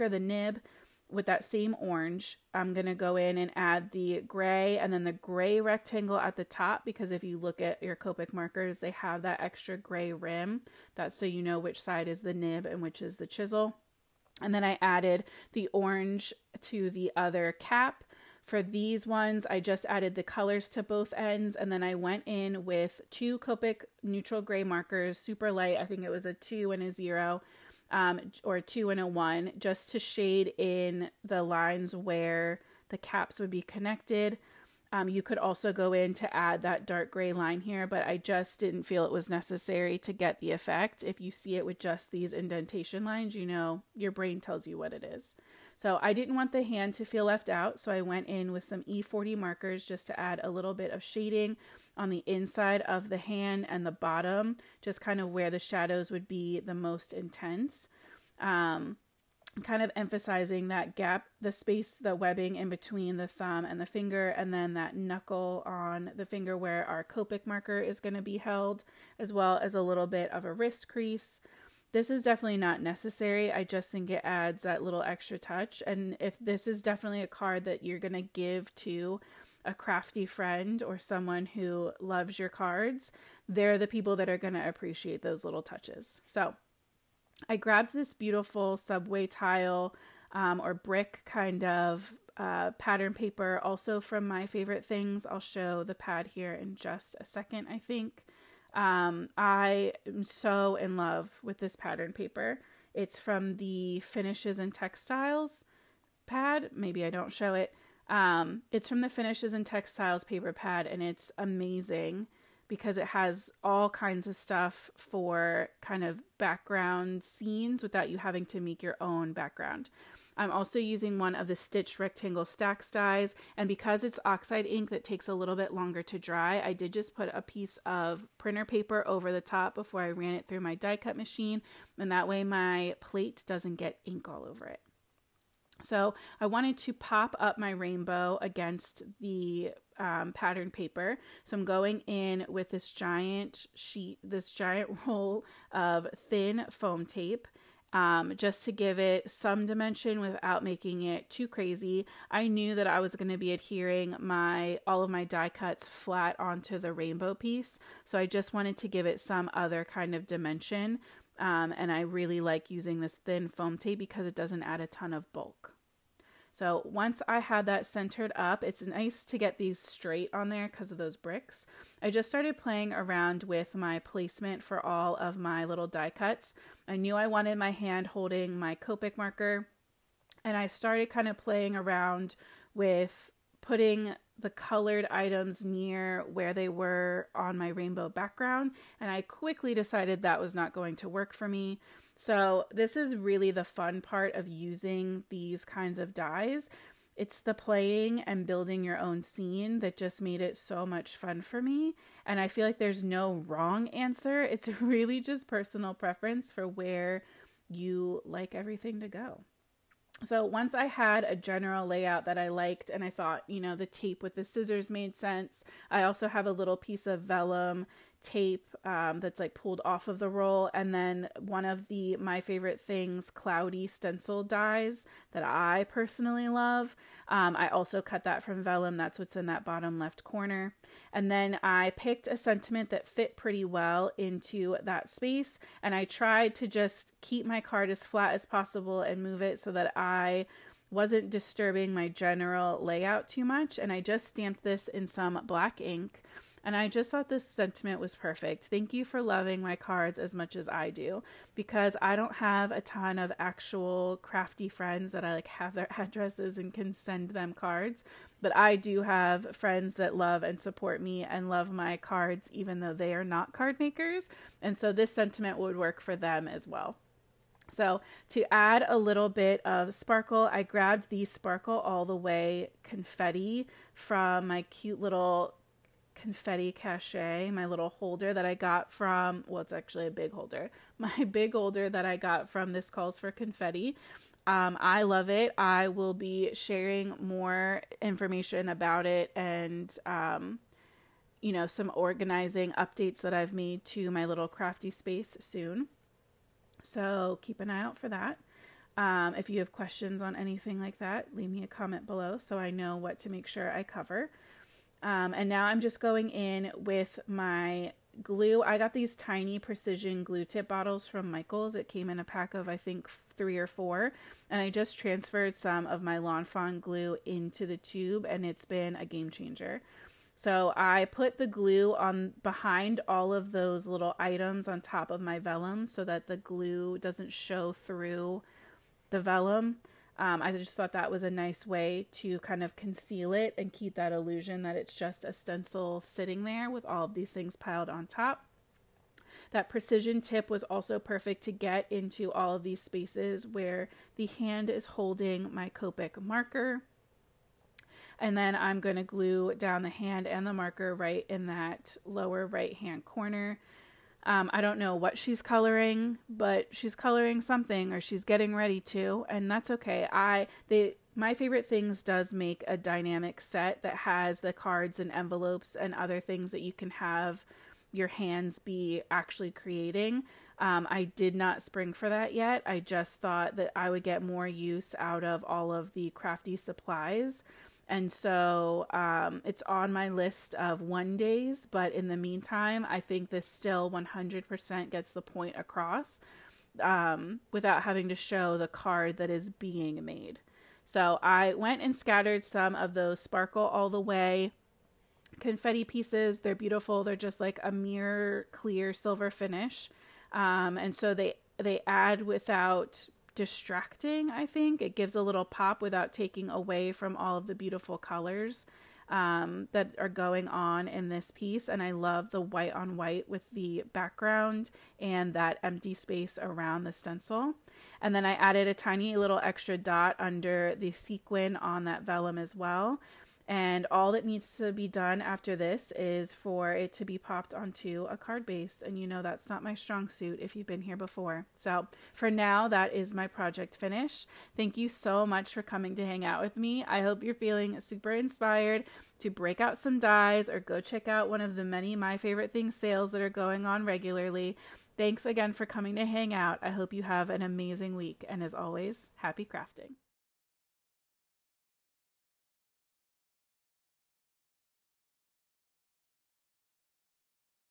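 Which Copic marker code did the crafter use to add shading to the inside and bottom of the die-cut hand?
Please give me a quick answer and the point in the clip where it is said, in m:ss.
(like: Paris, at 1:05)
E40, at 0:48.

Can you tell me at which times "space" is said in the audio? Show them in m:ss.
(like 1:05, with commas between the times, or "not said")
1:01, 3:55, 4:54, 5:42, 6:55.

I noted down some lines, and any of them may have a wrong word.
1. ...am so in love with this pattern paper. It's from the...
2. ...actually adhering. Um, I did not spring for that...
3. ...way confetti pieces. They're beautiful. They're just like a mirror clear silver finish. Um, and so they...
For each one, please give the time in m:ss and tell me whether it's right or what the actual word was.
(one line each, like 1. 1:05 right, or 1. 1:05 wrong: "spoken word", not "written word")
1. 1:40 right
2. 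6:09 wrong: "creating", not "adhering"
3. 6:33 right.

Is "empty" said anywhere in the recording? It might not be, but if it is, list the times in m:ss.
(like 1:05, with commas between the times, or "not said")
6:55.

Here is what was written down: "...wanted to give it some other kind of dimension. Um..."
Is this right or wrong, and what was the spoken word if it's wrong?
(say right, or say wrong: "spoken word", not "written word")
right.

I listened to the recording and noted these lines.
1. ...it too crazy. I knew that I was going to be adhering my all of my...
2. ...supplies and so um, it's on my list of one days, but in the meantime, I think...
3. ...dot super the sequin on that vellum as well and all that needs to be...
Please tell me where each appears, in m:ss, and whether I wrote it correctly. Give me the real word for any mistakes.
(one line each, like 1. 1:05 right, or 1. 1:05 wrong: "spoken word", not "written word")
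1. 2:31 right
2. 6:16 right
3. 6:59 wrong: "under", not "super".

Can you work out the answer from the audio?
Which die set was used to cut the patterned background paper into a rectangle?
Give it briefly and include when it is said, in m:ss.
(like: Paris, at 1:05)
Stitch Rectangle STAX, at 2:01.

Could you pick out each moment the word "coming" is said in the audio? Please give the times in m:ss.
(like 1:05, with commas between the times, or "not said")
7:15, 7:25.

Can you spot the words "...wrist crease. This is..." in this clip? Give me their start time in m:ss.
1:10.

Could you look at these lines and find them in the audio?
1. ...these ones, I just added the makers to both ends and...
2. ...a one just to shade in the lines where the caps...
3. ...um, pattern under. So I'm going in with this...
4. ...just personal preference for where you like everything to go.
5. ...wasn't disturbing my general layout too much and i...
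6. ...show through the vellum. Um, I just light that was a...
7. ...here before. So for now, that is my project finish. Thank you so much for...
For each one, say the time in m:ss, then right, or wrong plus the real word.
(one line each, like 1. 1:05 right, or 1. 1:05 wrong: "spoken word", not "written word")
1. 0:18 wrong: "colors", not "makers"
2. 0:29 right
3. 2:19 wrong: "paper", not "under"
4. 3:25 right
5. 4:00 right
6. 5:27 wrong: "thought", not "light"
7. 7:10 right.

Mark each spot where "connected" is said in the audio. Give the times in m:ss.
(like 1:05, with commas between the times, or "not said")
0:33.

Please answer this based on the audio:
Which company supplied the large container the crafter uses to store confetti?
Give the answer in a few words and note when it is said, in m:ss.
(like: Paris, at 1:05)
This Calls for Confetti, at 4:42.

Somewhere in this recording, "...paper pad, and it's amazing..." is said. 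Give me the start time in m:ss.
1:50.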